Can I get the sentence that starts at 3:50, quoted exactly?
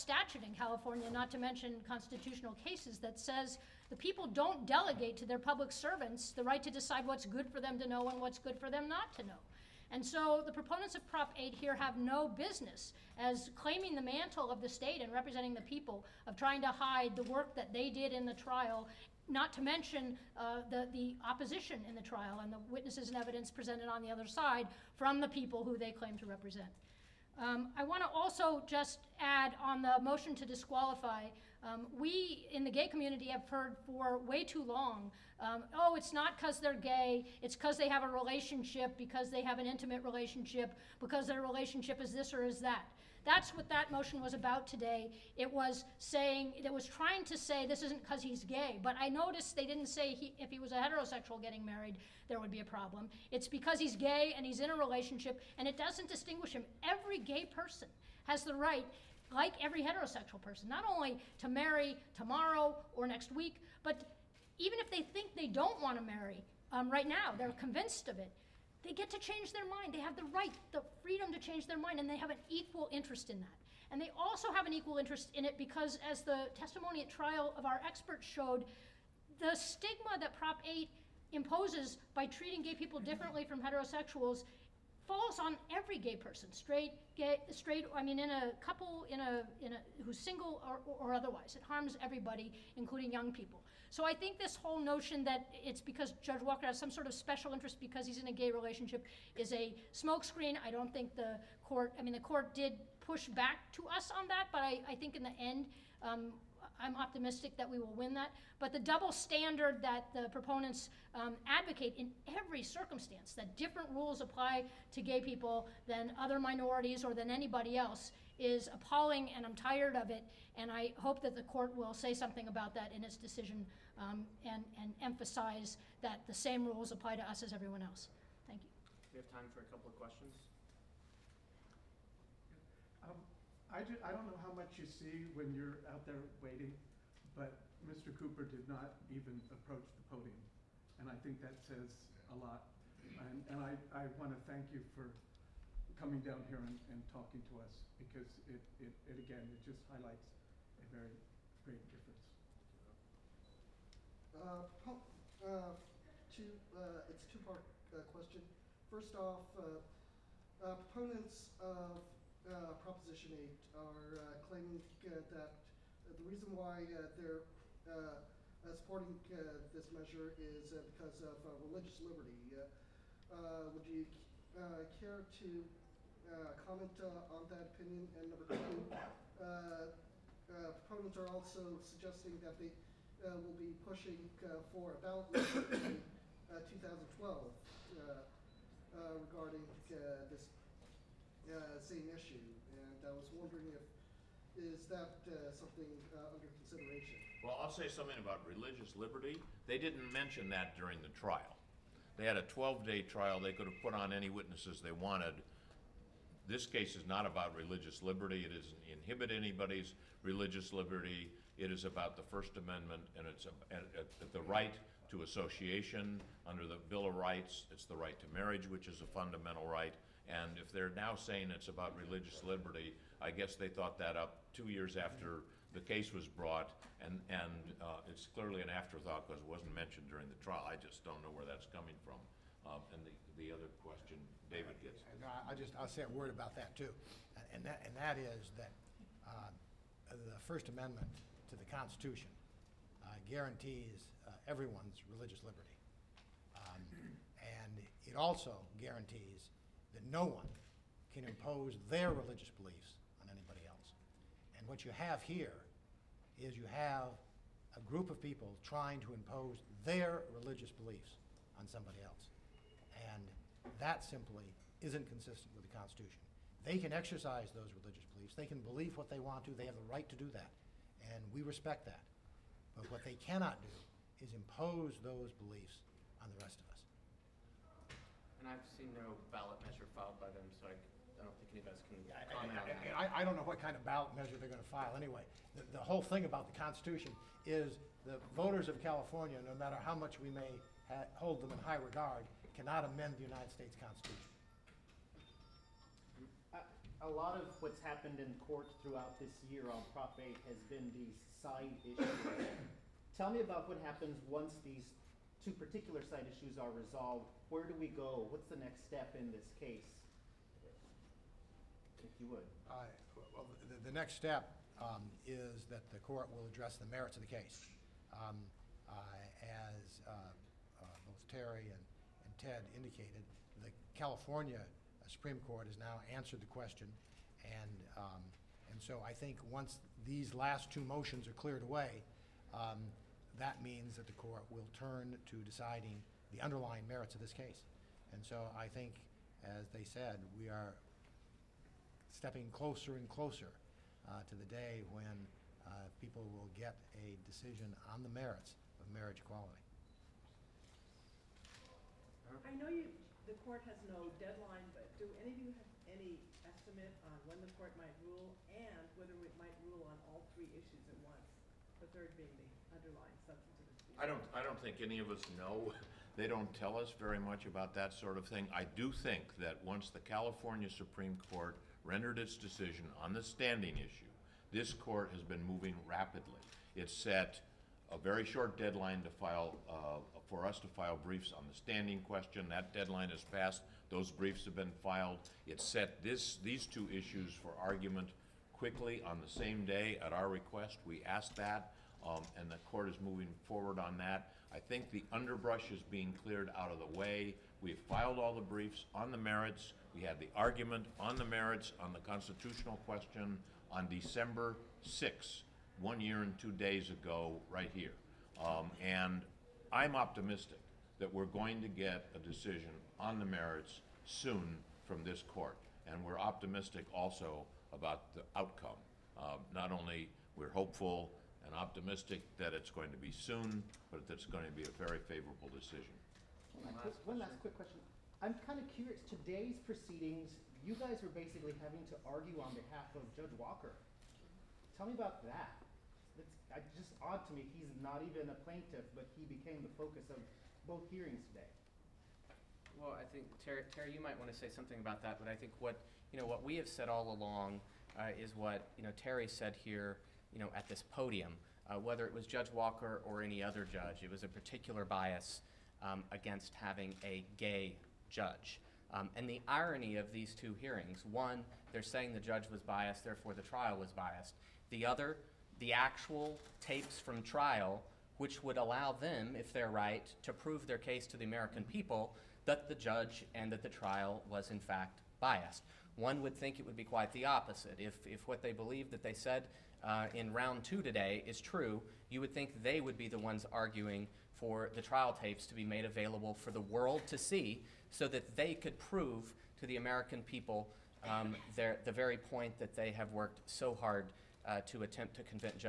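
I just don't know where that's coming from.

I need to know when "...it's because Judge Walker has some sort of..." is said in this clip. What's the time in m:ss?
1:35.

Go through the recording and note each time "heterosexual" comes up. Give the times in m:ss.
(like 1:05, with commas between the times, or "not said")
0:50, 0:59, 1:23.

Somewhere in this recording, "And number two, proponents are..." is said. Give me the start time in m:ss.
2:58.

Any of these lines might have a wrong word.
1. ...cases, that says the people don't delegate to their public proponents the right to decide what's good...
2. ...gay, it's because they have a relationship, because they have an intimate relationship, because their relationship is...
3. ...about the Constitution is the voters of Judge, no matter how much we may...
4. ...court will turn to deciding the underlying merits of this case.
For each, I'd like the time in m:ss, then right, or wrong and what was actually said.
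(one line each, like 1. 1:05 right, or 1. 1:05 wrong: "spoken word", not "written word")
1. 0:02 wrong: "servants", not "proponents"
2. 0:36 right
3. 4:46 wrong: "California", not "Judge"
4. 5:34 right.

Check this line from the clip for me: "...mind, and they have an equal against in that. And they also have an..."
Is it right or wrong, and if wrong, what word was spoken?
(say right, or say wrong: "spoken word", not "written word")
wrong: "interest", not "against".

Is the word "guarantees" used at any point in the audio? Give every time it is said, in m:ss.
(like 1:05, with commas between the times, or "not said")
4:03, 4:08.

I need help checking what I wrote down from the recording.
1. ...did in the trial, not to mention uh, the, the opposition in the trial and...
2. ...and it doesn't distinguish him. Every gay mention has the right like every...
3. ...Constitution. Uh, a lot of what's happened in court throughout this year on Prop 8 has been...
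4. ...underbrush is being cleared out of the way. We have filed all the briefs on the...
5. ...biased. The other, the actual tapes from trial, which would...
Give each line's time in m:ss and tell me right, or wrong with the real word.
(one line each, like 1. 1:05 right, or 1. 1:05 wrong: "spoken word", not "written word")
1. 0:17 right
2. 0:55 wrong: "person", not "mention"
3. 4:53 right
4. 6:35 right
5. 7:43 right.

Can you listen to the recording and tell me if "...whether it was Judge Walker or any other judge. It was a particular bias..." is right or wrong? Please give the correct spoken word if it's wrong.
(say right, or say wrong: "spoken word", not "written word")
right.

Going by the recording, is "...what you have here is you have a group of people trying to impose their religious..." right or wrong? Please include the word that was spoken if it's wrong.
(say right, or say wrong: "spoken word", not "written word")
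right.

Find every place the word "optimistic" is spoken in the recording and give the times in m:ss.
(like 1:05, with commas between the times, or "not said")
1:46, 6:49, 6:56, 7:01.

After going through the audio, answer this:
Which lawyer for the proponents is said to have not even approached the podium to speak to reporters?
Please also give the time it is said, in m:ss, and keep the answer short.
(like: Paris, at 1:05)
Mr. Cooper, at 2:17.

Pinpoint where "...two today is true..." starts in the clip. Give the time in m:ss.
8:00.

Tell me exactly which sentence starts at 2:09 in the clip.
We have time for a couple of questions.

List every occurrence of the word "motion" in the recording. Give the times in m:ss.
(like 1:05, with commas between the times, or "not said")
0:30, 0:43, 5:30.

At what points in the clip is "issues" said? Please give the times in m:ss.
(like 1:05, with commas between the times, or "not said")
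3:12, 5:01, 5:06, 6:00, 6:13, 6:26.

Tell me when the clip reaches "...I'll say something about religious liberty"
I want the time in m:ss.
3:17.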